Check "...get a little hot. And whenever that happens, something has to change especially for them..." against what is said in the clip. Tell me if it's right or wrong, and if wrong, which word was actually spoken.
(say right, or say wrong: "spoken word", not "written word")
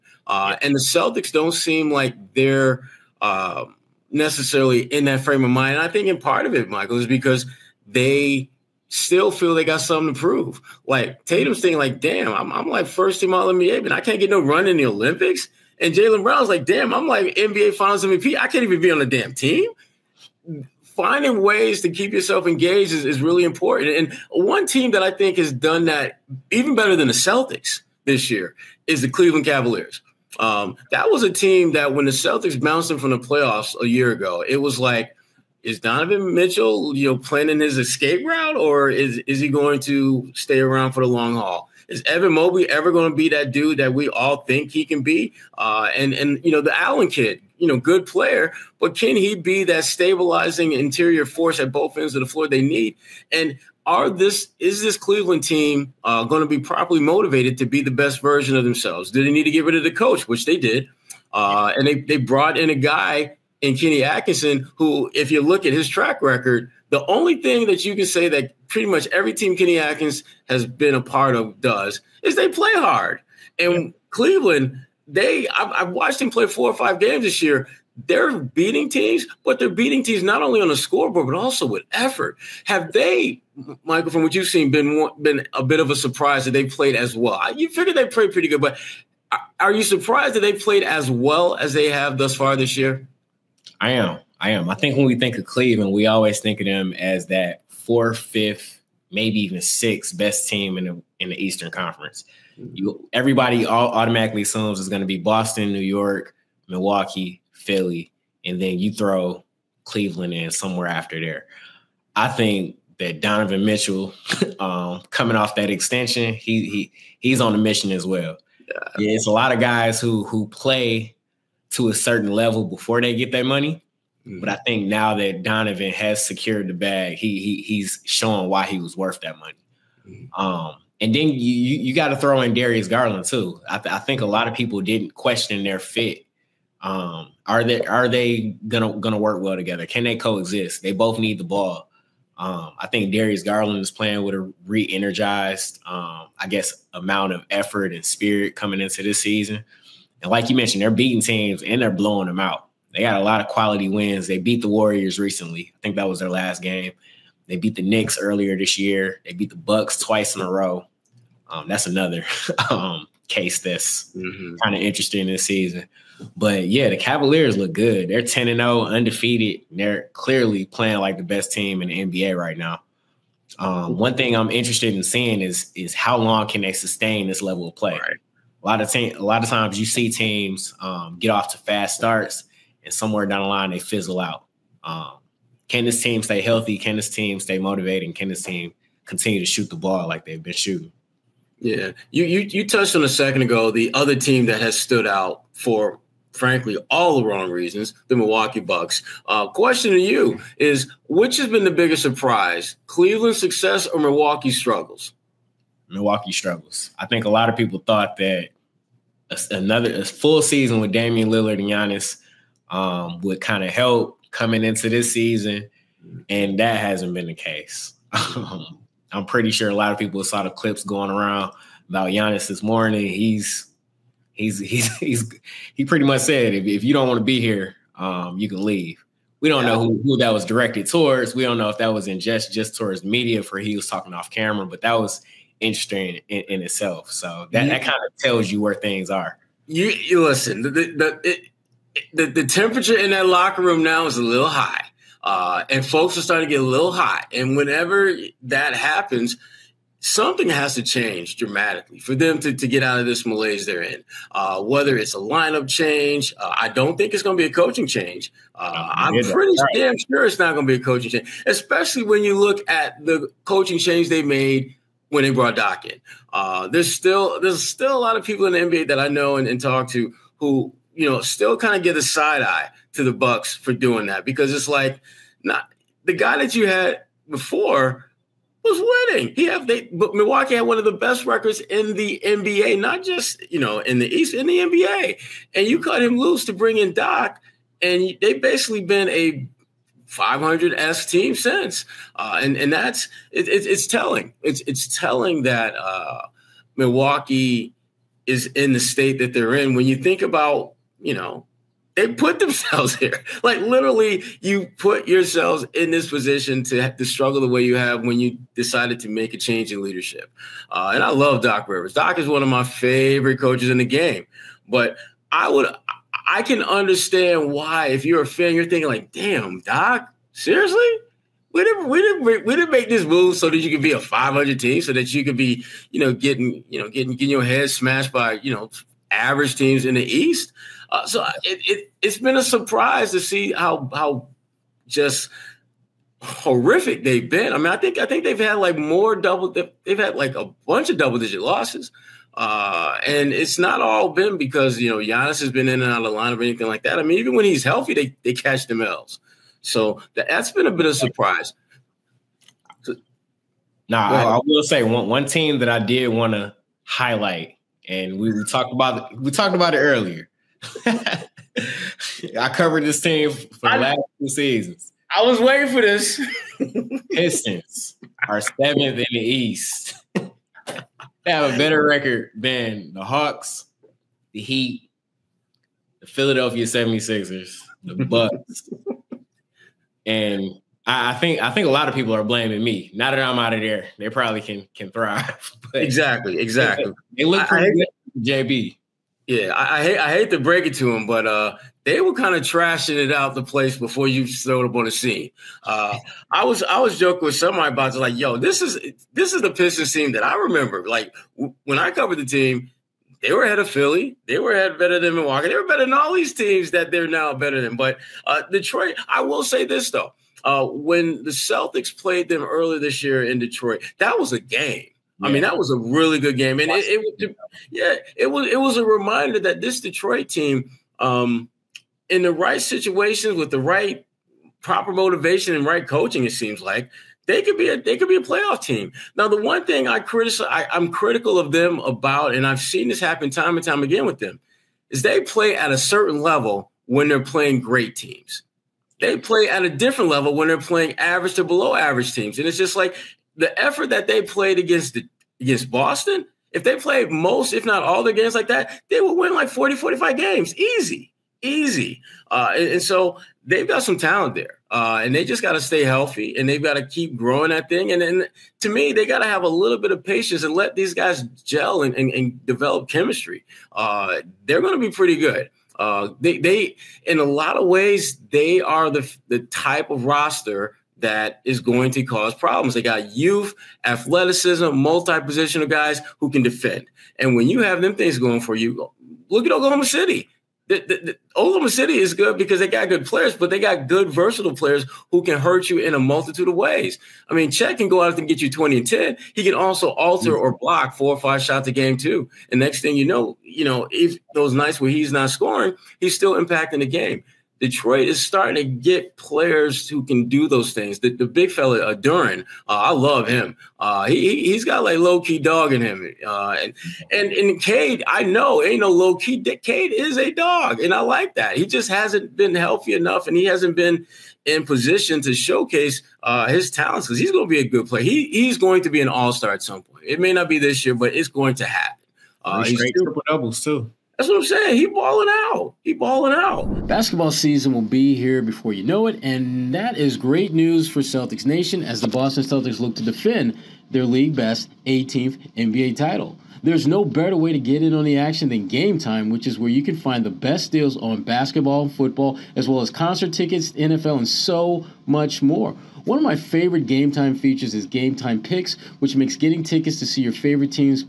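wrong: "dramatically", not "especially".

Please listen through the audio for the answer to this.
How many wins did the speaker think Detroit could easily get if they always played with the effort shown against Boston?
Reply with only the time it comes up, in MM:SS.
07:29.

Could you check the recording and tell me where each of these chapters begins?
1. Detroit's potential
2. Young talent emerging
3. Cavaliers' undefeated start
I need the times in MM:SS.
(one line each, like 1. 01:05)
1. 05:55
2. 07:46
3. 02:50.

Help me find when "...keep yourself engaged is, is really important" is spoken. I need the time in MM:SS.
00:21.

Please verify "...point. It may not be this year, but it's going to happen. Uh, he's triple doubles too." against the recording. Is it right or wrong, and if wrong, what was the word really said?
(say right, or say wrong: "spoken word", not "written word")
right.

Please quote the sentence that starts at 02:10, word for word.
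Um, and then you you, you got to throw in Darius Garland too.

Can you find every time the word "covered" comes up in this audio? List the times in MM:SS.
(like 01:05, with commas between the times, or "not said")
06:02, 06:41.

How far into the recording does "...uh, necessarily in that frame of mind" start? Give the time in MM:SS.
00:03.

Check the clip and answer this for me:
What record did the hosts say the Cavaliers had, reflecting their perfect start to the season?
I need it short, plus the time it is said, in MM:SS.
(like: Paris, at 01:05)
10 and 0, at 02:48.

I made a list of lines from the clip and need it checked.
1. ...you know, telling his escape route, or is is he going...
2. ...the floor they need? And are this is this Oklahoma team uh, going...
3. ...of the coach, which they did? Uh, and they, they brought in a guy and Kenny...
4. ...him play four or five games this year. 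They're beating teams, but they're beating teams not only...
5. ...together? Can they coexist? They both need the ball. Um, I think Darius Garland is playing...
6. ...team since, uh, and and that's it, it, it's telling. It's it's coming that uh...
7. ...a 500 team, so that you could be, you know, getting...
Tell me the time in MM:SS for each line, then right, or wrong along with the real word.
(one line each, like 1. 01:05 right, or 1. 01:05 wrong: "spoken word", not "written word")
1. 00:36 wrong: "planning", not "telling"
2. 00:52 wrong: "Cleveland", not "Oklahoma"
3. 00:59 right
4. 01:16 right
5. 02:19 right
6. 04:51 wrong: "telling", not "coming"
7. 05:23 right.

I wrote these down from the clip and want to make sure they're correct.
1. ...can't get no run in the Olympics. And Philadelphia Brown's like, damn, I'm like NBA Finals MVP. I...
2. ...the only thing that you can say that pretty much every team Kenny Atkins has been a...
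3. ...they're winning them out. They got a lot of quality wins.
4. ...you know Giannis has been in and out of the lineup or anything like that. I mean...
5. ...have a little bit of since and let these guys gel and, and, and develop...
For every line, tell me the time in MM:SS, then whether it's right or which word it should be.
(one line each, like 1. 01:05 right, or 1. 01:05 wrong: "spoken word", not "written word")
1. 00:14 wrong: "Jaylen", not "Philadelphia"
2. 01:06 right
3. 02:31 wrong: "blowing", not "winning"
4. 05:44 right
5. 07:39 wrong: "patience", not "since".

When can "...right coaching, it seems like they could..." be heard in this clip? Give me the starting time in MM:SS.
07:05.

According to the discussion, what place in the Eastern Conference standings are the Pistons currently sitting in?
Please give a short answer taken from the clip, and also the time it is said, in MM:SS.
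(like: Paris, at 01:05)
seventh, at 06:08.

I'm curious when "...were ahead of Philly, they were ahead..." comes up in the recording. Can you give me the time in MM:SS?
06:43.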